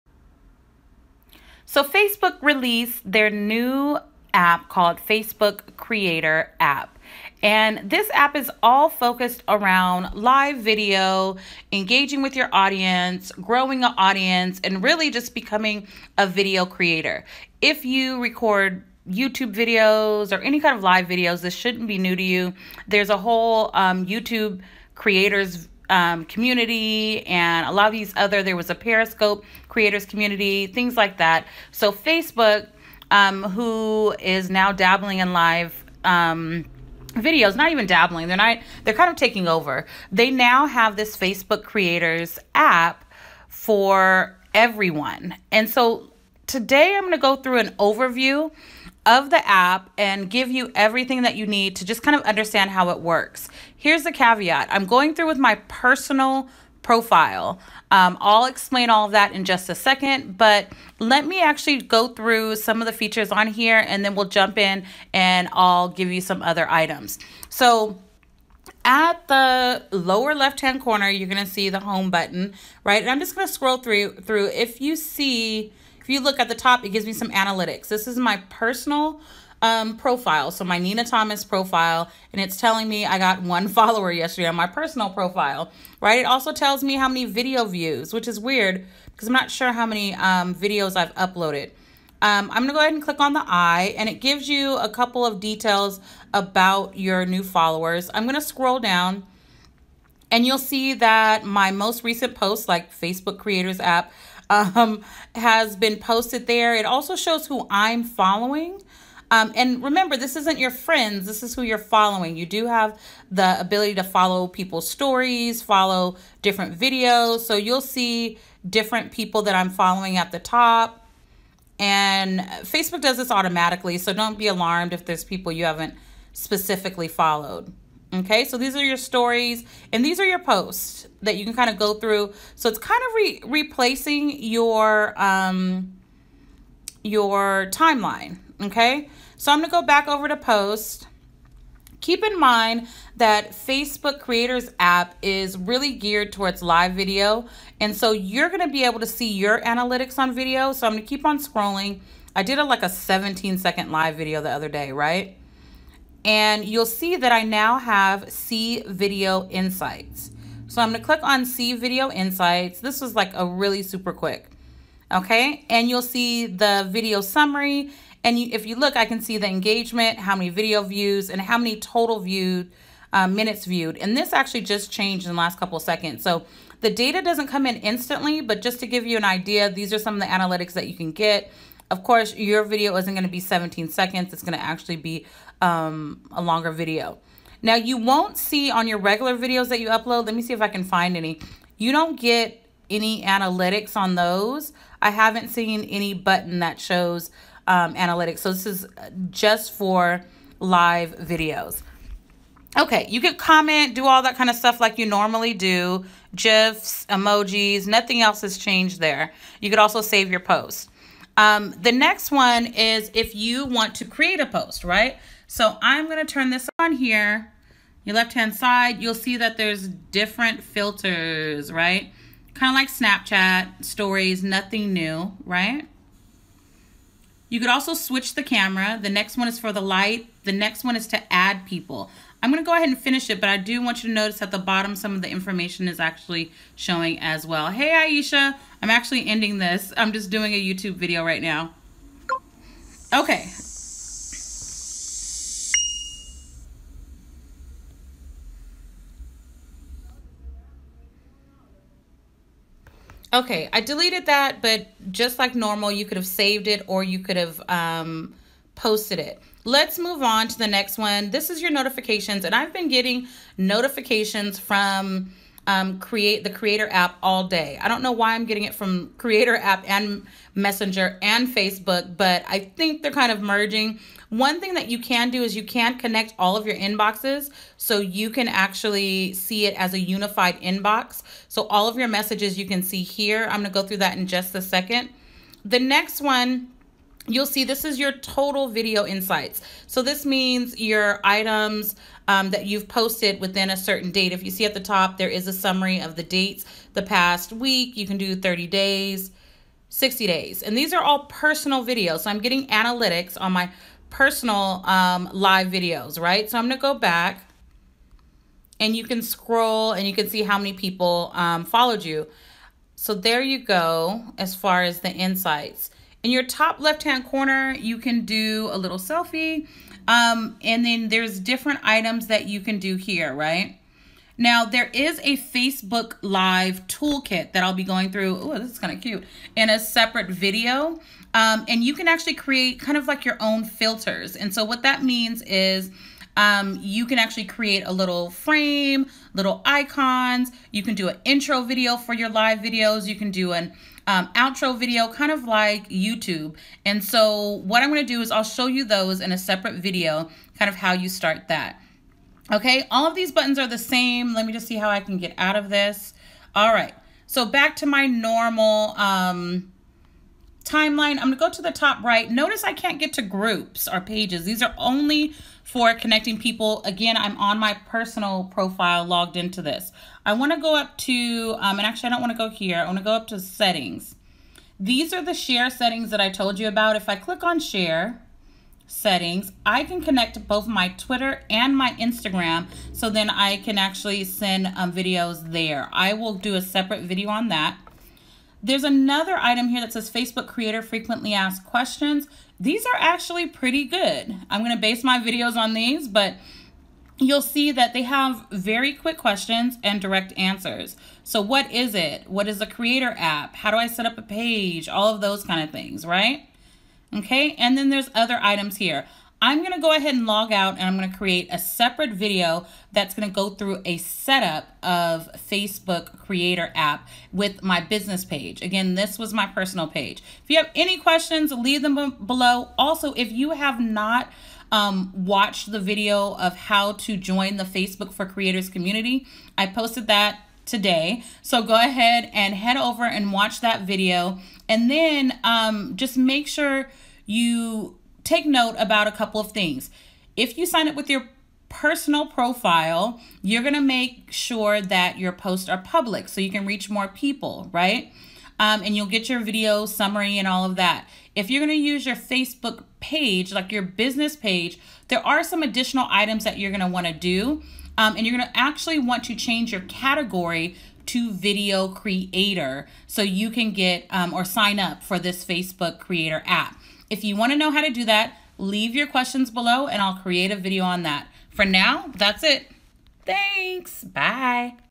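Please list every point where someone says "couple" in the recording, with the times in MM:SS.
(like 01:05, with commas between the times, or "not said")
01:34, 02:55, 07:19.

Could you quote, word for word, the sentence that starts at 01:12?
And I'm just going to scroll through through if you see if you look at the top, it gives me some analytics.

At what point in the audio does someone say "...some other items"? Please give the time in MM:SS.
01:06.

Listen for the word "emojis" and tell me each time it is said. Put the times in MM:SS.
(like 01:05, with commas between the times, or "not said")
03:27.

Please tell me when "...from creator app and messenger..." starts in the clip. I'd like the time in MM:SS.
04:28.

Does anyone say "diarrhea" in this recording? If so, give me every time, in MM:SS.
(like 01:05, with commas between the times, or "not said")
not said.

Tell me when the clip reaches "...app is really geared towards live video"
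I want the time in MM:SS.
02:24.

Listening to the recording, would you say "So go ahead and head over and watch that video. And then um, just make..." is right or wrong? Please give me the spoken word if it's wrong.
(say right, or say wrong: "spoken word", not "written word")
right.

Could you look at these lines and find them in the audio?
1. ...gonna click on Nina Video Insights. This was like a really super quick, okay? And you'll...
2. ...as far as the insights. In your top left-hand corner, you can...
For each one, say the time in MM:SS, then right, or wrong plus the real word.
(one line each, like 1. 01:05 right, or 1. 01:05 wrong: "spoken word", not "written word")
1. 02:40 wrong: "See", not "Nina"
2. 05:14 right.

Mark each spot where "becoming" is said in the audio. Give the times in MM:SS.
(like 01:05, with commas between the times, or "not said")
00:15.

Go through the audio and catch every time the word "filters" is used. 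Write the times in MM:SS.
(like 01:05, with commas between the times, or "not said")
03:40, 05:33.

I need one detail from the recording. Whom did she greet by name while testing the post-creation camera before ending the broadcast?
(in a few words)
Aisha.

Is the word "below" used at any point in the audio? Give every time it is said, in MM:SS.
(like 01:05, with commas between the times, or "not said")
07:02, 07:49.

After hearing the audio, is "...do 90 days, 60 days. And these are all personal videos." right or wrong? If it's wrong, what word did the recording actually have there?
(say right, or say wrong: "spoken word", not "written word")
wrong: "30", not "90".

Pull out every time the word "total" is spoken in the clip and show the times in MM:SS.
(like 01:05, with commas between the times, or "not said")
02:51, 04:48.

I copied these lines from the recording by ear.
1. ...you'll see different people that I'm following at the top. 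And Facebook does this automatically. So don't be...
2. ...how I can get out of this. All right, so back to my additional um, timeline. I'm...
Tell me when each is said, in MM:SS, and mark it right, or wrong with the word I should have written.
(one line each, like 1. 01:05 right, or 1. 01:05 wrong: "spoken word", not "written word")
1. 01:57 right
2. 05:54 wrong: "normal", not "additional".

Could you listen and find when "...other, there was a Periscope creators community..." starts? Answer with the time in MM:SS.
00:28.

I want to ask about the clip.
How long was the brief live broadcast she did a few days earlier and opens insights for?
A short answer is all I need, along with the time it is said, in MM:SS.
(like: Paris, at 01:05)
17 seconds, at 02:32.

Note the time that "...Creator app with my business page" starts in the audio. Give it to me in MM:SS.
06:56.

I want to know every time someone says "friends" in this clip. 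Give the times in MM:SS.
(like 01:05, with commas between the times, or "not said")
01:50.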